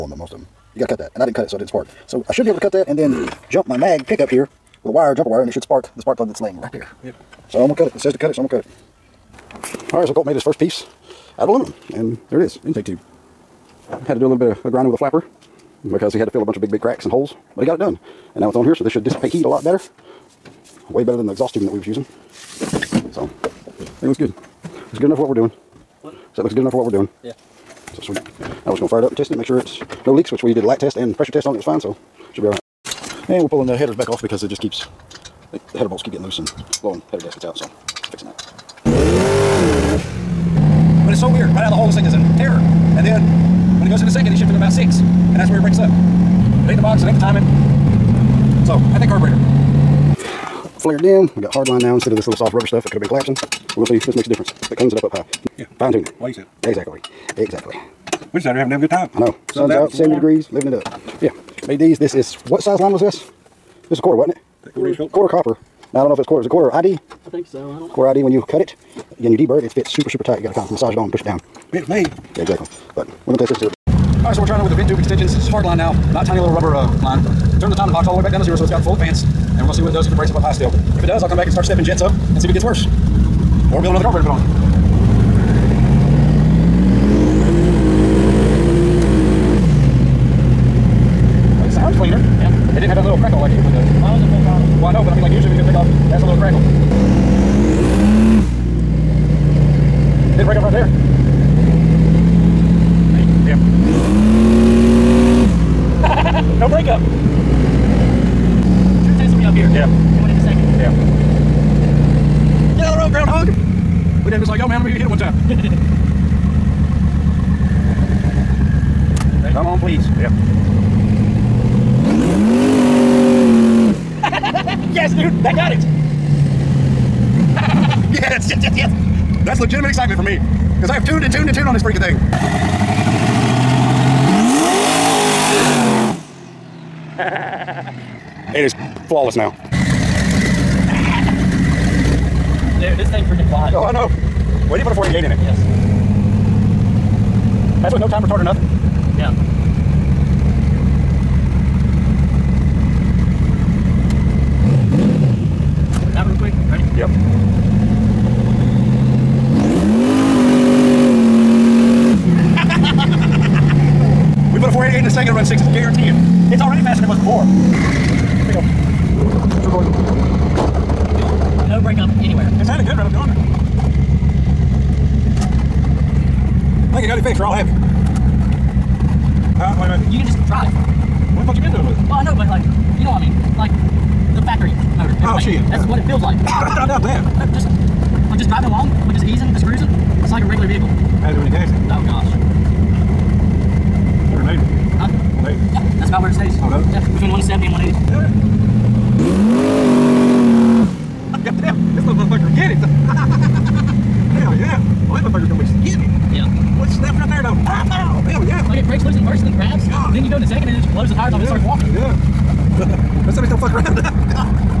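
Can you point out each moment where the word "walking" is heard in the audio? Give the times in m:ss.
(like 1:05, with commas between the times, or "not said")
3:31.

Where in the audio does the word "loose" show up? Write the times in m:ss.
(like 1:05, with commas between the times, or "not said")
0:36, 3:29.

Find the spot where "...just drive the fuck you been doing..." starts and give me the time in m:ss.
3:00.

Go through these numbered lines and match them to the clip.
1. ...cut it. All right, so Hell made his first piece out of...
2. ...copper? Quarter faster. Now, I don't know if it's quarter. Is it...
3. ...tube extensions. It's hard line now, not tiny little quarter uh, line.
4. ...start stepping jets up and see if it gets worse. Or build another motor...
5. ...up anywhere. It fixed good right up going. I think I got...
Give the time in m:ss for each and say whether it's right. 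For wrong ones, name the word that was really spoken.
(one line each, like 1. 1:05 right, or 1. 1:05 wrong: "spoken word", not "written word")
1. 0:08 wrong: "Colt", not "Hell"
2. 1:04 wrong: "copper", not "faster"
3. 1:14 wrong: "rubber", not "quarter"
4. 1:21 wrong: "carburetor", not "motor"
5. 2:51 wrong: "sounded", not "fixed".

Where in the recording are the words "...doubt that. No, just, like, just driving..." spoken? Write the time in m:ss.
3:06.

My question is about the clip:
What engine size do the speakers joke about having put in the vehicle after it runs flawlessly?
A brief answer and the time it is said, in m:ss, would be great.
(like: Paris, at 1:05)
488, at 2:24.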